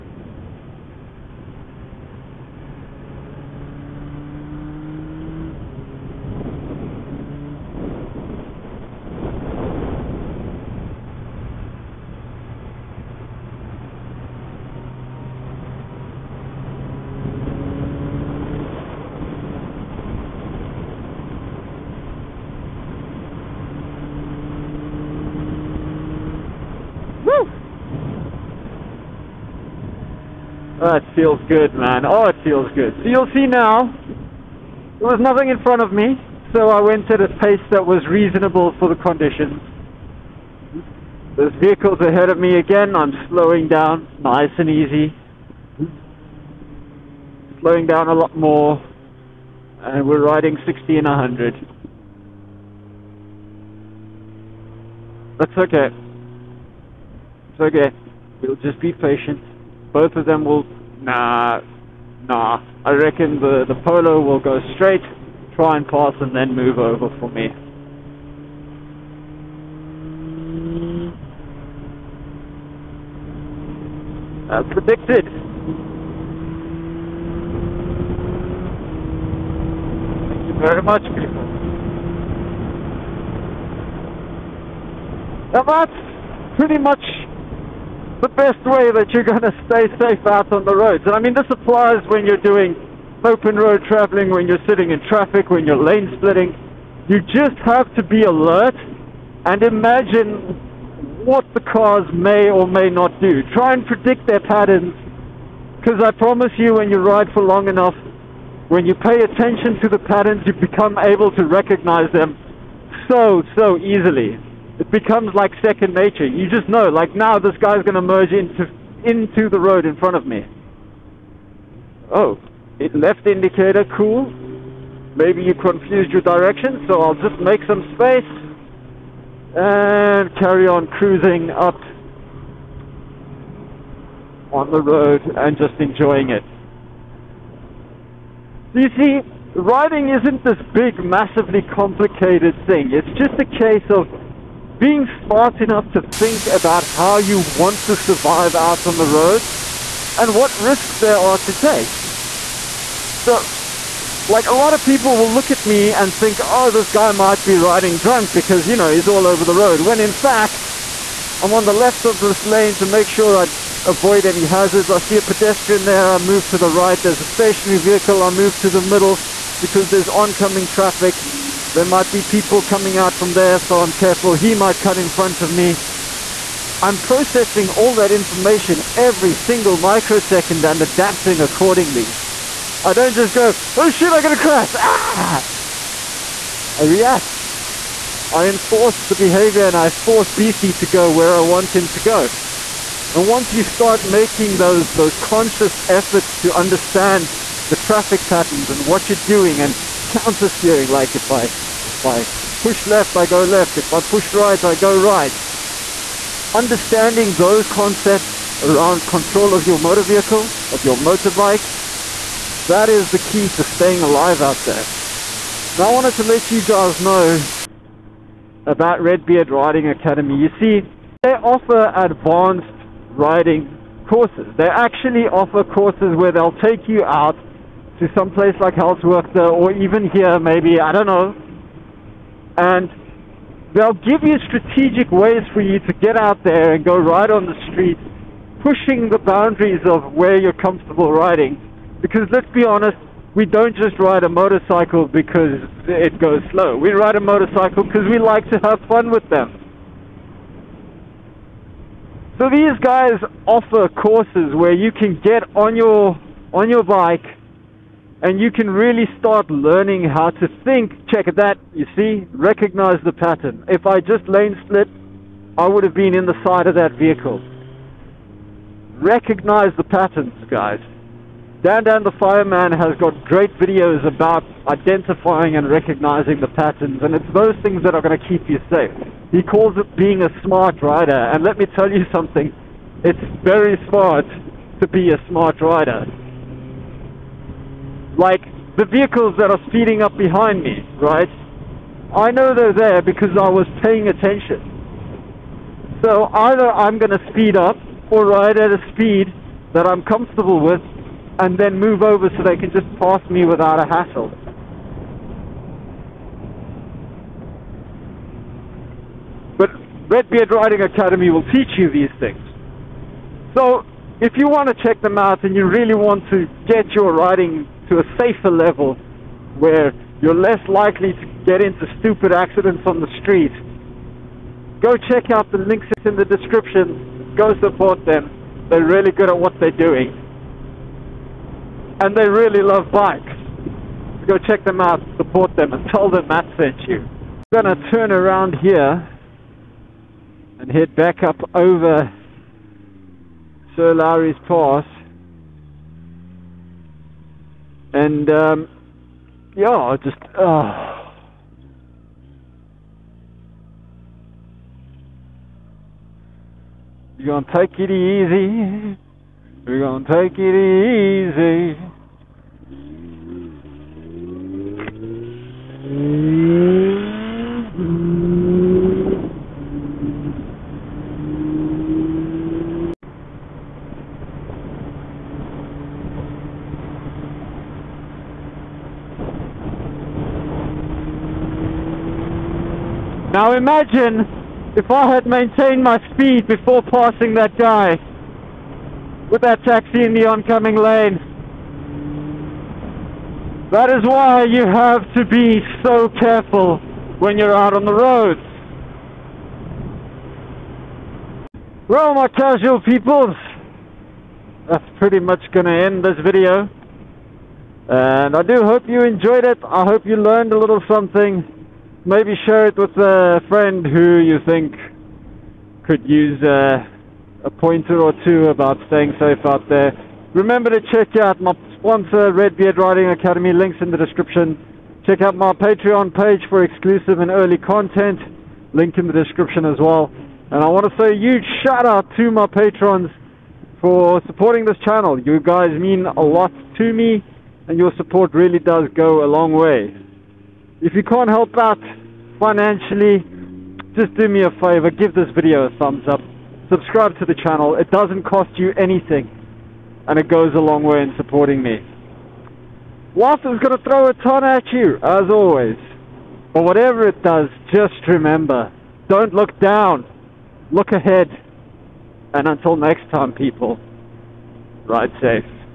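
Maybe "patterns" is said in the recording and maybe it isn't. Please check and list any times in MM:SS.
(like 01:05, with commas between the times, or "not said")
01:44, 01:50, 03:18, 04:23, 04:29, 04:36.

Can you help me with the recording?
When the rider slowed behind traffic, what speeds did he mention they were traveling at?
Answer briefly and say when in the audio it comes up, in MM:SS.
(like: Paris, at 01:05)
60 and 100, at 00:50.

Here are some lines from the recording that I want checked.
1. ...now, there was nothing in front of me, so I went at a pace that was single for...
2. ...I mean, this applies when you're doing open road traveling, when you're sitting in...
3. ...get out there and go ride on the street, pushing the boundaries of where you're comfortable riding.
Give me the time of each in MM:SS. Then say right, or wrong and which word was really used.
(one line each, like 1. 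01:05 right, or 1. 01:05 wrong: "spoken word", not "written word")
1. 00:33 wrong: "reasonable", not "single"
2. 01:31 right
3. 03:56 right.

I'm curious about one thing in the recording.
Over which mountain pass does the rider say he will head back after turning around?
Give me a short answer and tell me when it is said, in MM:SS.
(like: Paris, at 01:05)
Sir Lowry's Pass, at 05:43.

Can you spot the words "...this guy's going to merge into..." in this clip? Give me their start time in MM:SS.
01:57.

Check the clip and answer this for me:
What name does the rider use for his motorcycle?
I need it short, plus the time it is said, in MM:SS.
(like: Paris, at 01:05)
Beastie, at 03:10.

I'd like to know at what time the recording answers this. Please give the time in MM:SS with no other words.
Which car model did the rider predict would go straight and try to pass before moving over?
01:03.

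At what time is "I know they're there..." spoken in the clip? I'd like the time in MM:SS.
04:52.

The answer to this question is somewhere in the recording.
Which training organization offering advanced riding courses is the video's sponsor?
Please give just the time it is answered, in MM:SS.
03:39.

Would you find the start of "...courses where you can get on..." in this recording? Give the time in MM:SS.
04:13.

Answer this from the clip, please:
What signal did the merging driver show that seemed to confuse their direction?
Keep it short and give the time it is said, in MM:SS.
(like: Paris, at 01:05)
Left indicator, at 02:02.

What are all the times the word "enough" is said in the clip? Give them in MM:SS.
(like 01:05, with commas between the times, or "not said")
01:47, 02:25.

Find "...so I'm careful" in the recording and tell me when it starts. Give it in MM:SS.
02:53.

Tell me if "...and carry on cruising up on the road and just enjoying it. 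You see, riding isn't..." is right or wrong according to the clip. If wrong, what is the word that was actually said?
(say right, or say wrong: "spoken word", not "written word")
right.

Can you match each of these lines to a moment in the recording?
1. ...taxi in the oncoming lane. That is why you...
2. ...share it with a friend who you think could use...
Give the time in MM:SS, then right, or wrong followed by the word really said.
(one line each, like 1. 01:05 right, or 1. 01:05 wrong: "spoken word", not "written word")
1. 06:29 right
2. 06:52 right.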